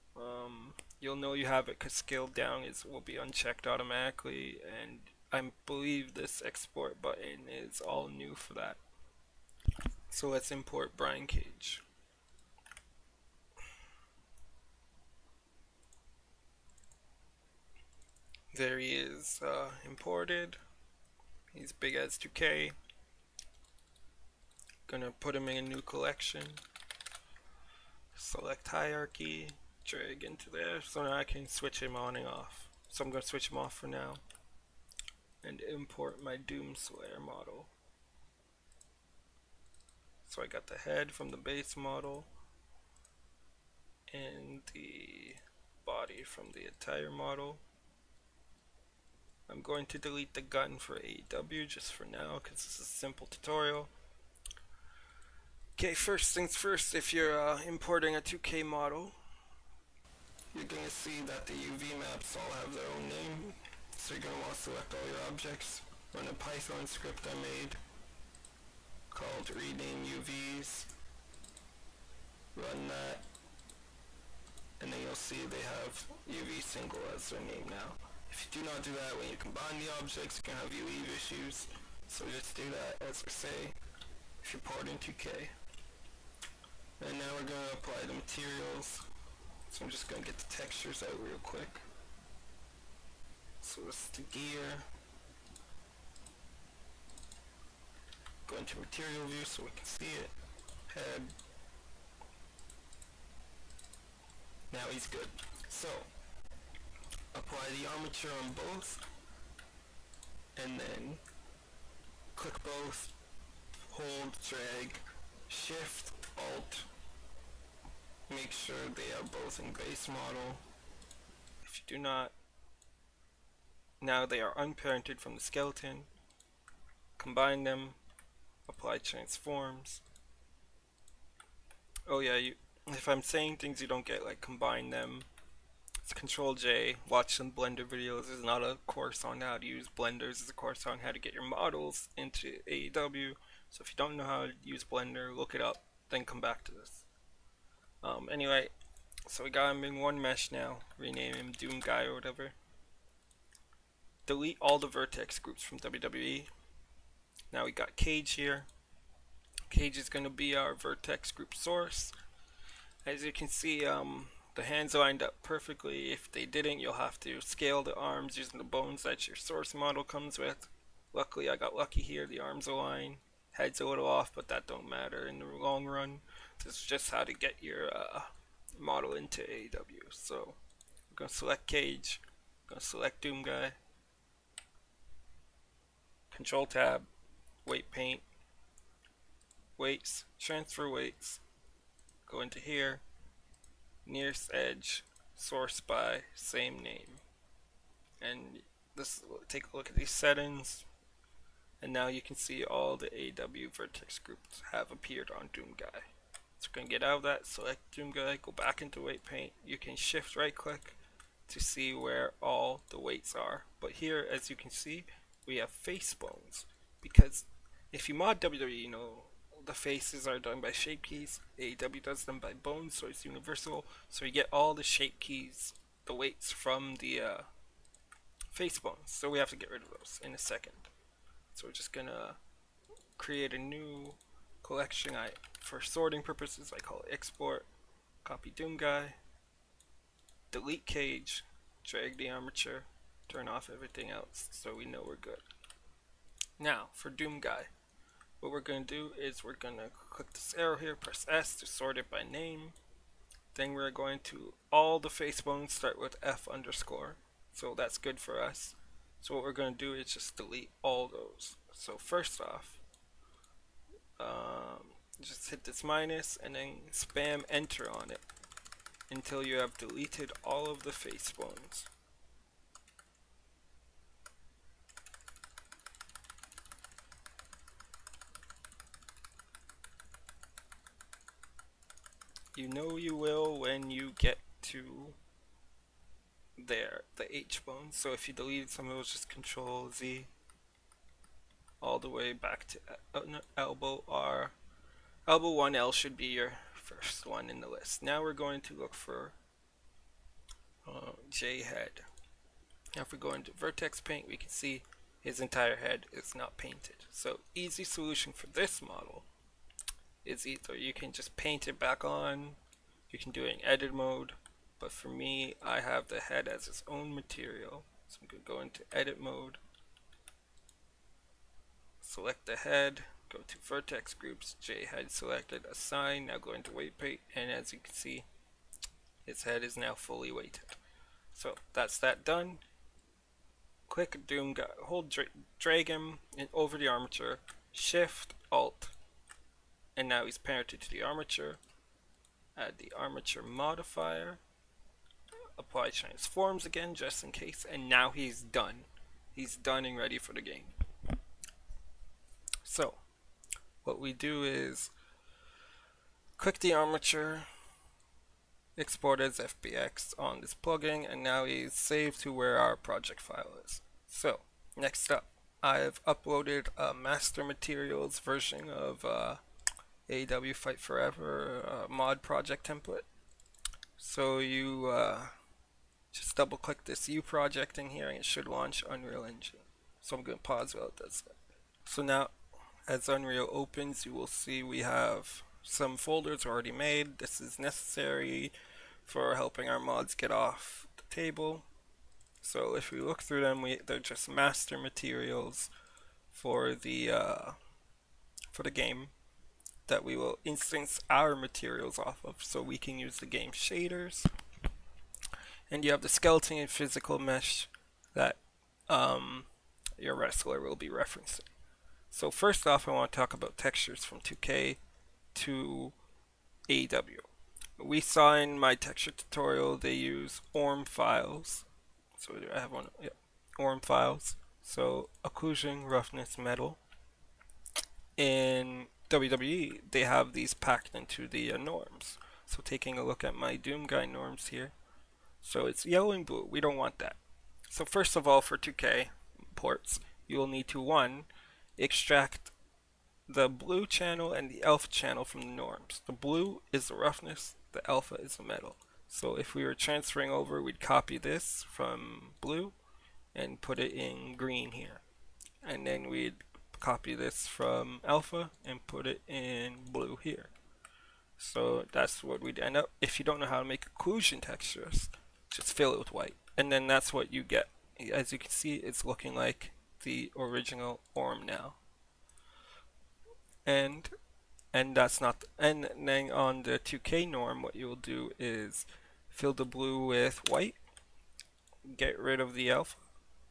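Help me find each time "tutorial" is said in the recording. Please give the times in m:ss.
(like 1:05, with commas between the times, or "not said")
0:53, 6:59.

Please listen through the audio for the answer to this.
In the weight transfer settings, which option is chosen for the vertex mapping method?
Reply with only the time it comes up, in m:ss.
3:14.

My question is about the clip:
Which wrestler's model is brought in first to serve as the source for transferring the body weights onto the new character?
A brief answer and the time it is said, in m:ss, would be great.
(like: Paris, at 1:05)
Brian Cage, at 0:10.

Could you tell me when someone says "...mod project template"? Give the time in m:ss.
6:11.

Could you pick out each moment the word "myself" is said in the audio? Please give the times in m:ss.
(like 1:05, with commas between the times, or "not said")
not said.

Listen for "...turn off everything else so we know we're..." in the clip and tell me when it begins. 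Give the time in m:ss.
4:03.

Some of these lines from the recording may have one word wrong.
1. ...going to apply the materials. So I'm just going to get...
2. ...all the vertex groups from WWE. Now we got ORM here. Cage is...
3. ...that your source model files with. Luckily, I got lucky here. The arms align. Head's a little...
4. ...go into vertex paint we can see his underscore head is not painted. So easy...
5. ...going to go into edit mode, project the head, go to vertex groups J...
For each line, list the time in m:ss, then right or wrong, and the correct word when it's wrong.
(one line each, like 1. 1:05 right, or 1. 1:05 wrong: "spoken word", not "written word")
1. 1:27 right
2. 2:34 wrong: "Cage", not "ORM"
3. 2:49 wrong: "comes", not "files"
4. 5:03 wrong: "entire", not "underscore"
5. 5:18 wrong: "select", not "project".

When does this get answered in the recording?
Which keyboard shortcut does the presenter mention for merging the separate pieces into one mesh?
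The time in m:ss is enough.
2:16.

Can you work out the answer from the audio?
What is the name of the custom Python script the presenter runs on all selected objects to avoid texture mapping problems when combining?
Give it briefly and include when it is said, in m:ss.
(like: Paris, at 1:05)
rename UVs, at 1:09.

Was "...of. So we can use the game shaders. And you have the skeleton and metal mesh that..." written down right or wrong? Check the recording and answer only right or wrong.
wrong.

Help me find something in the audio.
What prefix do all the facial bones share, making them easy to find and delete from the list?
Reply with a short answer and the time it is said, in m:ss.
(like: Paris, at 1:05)
F underscore, at 4:16.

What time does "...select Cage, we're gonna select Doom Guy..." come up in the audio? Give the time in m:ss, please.
3:01.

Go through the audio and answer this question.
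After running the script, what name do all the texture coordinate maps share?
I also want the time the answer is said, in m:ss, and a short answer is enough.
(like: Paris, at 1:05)
UV single, at 1:16.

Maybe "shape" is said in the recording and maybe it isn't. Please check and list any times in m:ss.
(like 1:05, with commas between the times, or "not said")
3:40, 3:44.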